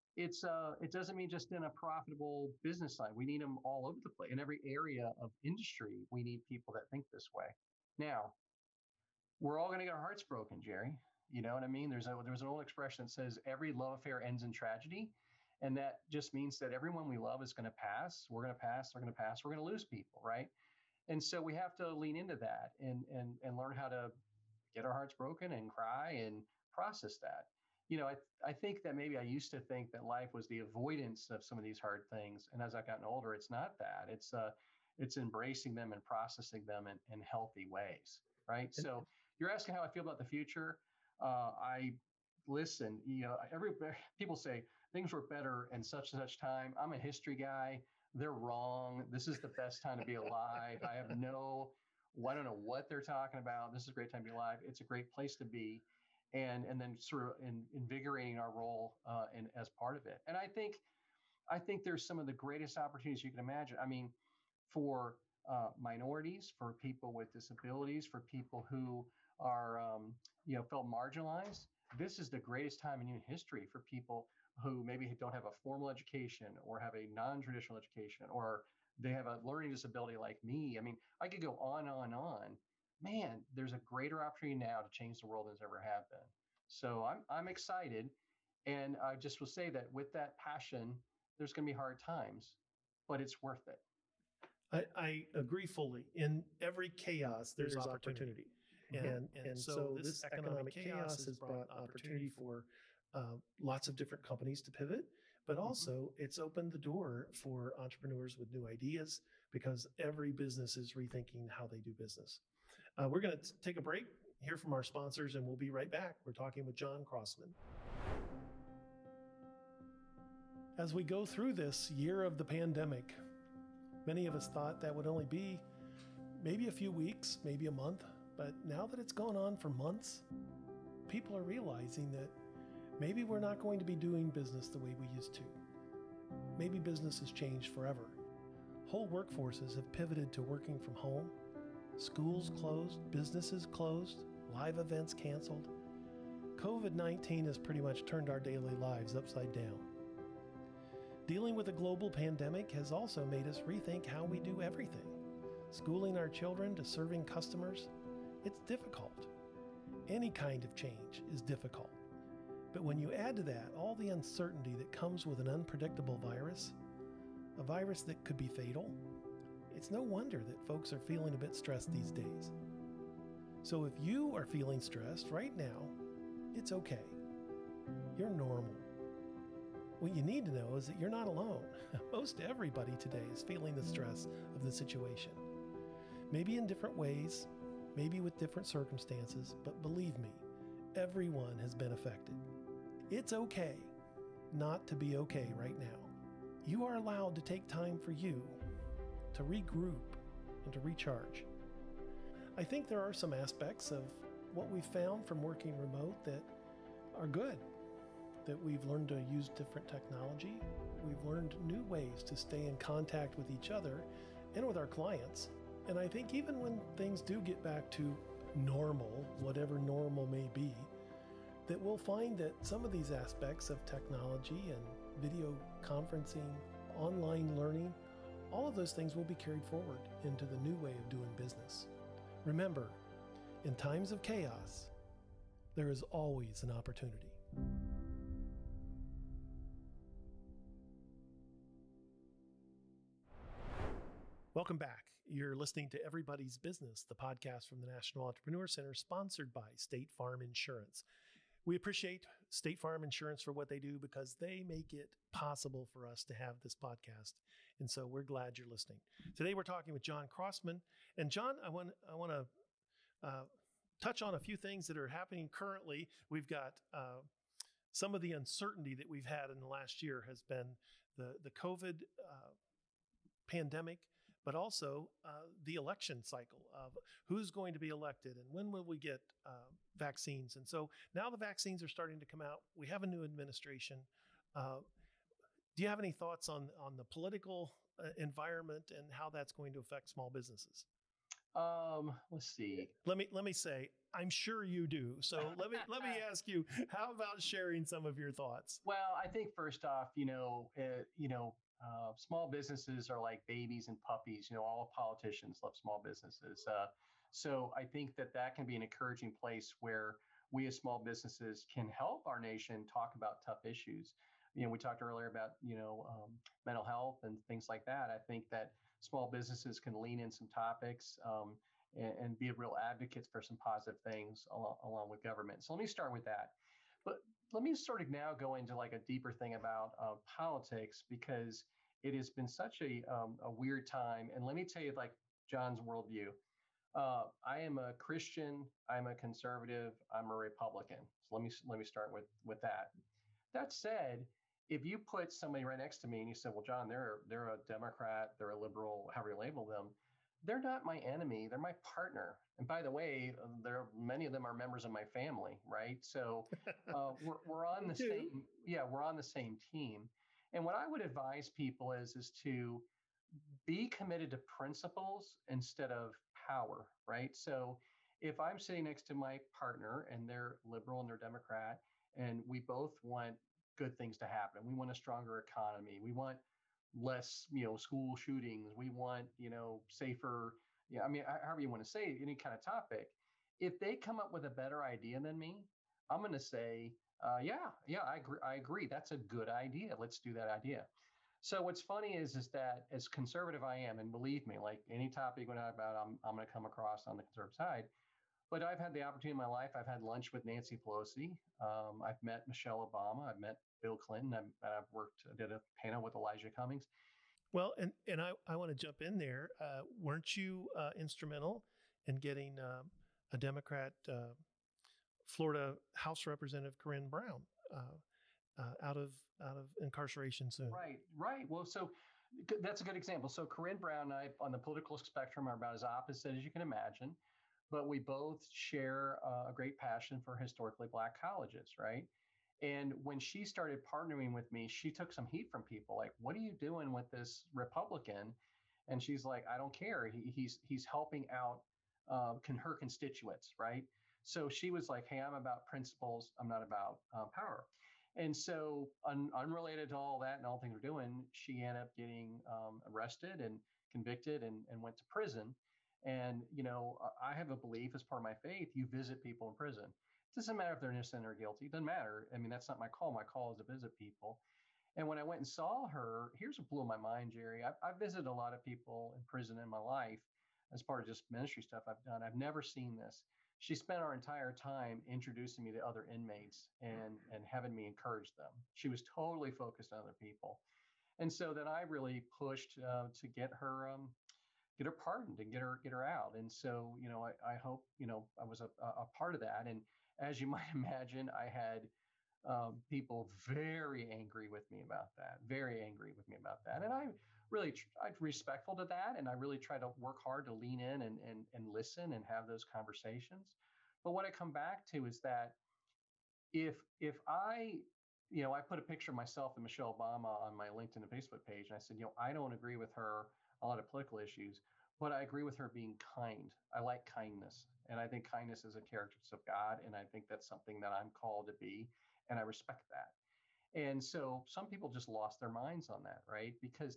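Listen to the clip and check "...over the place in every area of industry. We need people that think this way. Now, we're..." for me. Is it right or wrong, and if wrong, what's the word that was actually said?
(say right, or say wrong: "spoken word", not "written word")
right.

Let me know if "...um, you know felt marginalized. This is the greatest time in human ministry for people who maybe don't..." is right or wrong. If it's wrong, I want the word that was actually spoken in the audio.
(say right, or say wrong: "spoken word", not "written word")
wrong: "history", not "ministry".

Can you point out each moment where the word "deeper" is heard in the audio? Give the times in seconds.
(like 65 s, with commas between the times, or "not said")
328 s.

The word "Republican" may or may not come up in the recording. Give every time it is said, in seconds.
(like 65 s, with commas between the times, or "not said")
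340 s, 437 s.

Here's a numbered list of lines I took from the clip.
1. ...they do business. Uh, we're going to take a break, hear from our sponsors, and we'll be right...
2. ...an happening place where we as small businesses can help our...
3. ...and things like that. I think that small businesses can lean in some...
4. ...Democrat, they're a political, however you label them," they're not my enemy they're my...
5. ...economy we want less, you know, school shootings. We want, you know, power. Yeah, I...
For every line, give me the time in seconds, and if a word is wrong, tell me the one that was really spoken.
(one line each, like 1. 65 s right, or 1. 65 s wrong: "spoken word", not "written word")
1. 111 s right
2. 308 s wrong: "encouraging", not "happening"
3. 317 s right
4. 347 s wrong: "liberal", not "political"
5. 375 s wrong: "safer", not "power".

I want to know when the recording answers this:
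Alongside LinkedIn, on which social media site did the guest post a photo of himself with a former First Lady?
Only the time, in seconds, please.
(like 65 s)
511 s.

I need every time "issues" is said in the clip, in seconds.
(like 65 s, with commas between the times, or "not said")
313 s, 514 s.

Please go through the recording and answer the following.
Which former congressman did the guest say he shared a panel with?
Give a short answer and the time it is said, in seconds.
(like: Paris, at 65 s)
Elijah Cummings, at 406 s.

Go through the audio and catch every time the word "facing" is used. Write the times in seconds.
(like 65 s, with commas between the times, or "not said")
not said.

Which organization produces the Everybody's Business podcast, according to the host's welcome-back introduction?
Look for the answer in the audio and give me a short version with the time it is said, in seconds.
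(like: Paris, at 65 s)
National Entrepreneur Center, at 247 s.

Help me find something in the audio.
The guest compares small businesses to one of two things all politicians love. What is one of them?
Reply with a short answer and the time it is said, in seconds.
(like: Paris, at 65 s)
babies, at 303 s.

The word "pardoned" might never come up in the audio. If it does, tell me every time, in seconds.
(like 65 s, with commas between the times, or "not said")
484 s.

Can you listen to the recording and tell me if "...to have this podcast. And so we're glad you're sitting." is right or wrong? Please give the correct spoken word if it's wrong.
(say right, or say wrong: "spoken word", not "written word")
wrong: "listening", not "sitting".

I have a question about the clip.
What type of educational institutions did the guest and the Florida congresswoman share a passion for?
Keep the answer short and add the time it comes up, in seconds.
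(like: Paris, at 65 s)
historically black colleges, at 430 s.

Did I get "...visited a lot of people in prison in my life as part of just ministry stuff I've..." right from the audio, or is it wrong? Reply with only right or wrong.
right.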